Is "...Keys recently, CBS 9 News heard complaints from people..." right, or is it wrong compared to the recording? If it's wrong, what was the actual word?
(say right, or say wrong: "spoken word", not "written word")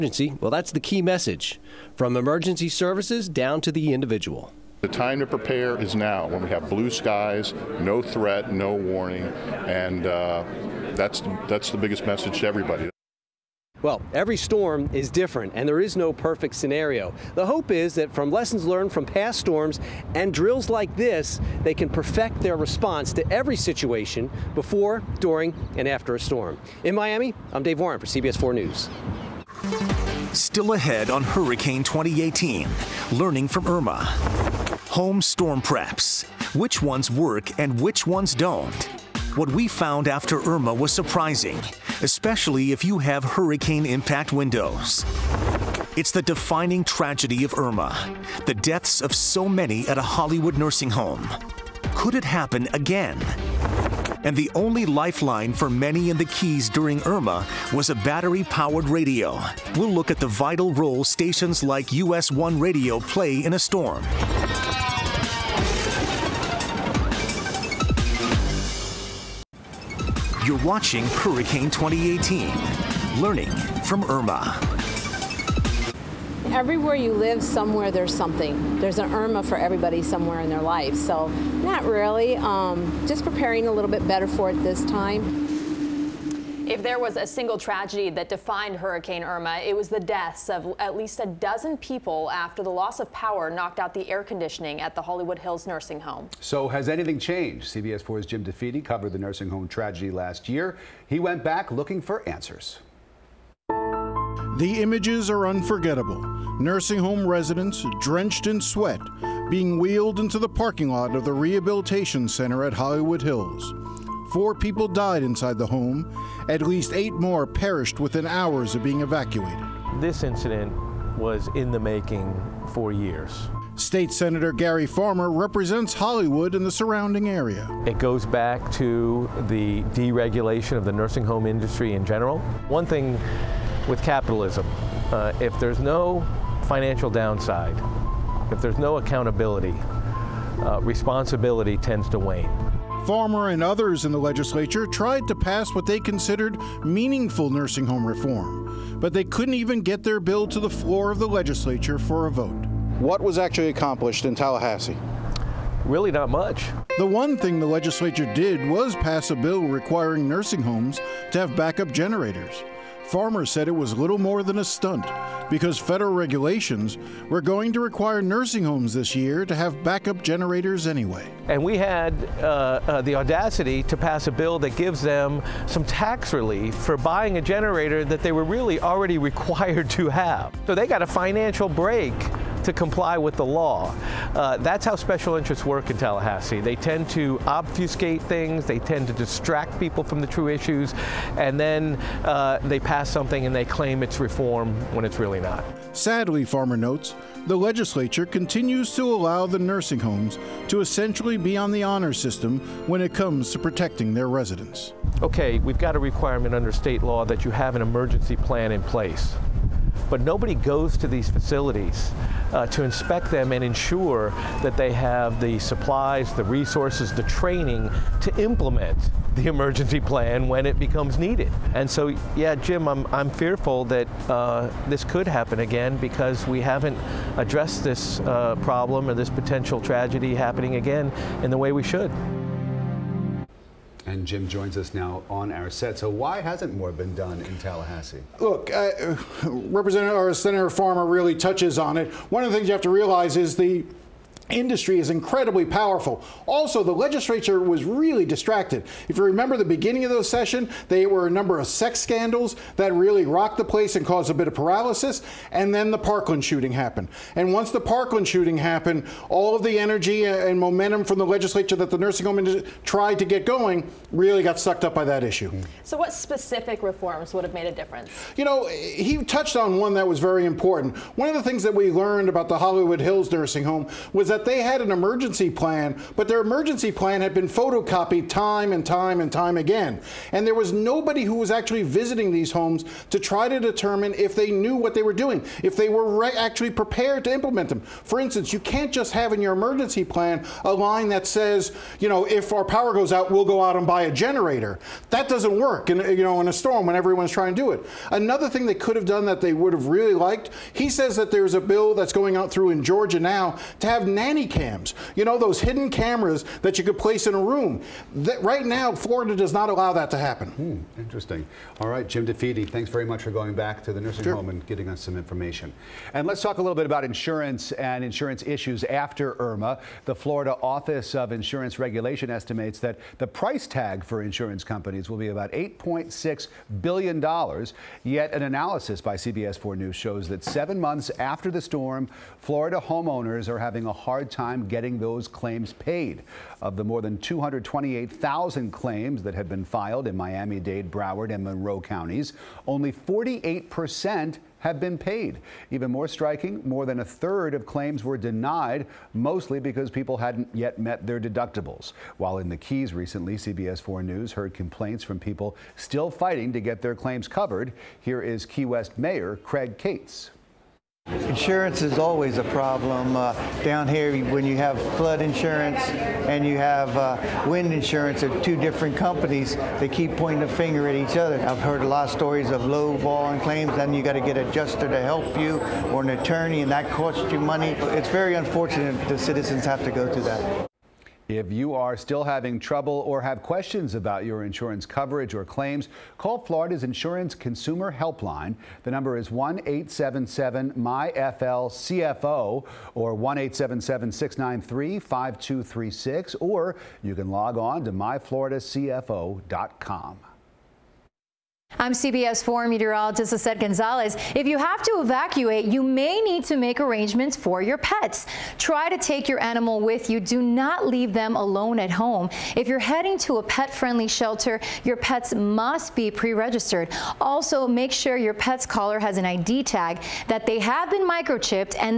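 wrong: "4", not "9".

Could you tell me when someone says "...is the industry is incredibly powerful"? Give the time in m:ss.
4:03.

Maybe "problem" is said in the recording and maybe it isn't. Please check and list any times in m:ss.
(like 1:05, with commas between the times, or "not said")
3:48, 6:02.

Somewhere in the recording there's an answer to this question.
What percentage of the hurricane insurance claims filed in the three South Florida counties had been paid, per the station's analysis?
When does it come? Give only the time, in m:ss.
5:42.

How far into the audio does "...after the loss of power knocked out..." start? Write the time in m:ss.
1:32.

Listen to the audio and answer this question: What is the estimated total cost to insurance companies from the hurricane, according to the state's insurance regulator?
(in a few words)
$8.6 billion.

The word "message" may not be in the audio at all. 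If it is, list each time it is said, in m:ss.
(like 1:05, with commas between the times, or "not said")
0:01, 0:12.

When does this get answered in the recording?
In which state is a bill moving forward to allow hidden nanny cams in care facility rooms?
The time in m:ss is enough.
5:02.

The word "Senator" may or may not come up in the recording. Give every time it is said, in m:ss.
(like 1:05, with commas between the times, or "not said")
2:04, 4:00.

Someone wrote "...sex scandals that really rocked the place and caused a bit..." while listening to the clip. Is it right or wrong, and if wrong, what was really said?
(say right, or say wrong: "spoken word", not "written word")
right.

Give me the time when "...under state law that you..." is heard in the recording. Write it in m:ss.
3:26.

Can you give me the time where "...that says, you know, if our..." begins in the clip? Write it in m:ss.
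4:51.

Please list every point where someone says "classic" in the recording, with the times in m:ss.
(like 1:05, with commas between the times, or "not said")
not said.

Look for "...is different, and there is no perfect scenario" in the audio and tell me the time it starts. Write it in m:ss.
0:14.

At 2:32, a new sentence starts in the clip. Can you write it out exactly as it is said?
What was actually accomplished in Tallahassee?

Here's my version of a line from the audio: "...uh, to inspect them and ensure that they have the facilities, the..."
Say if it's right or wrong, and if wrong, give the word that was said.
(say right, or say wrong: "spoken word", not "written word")
wrong: "supplies", not "facilities".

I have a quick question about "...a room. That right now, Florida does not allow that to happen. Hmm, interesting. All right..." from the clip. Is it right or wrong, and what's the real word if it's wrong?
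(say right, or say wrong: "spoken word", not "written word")
right.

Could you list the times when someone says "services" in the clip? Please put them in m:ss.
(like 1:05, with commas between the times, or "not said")
0:02.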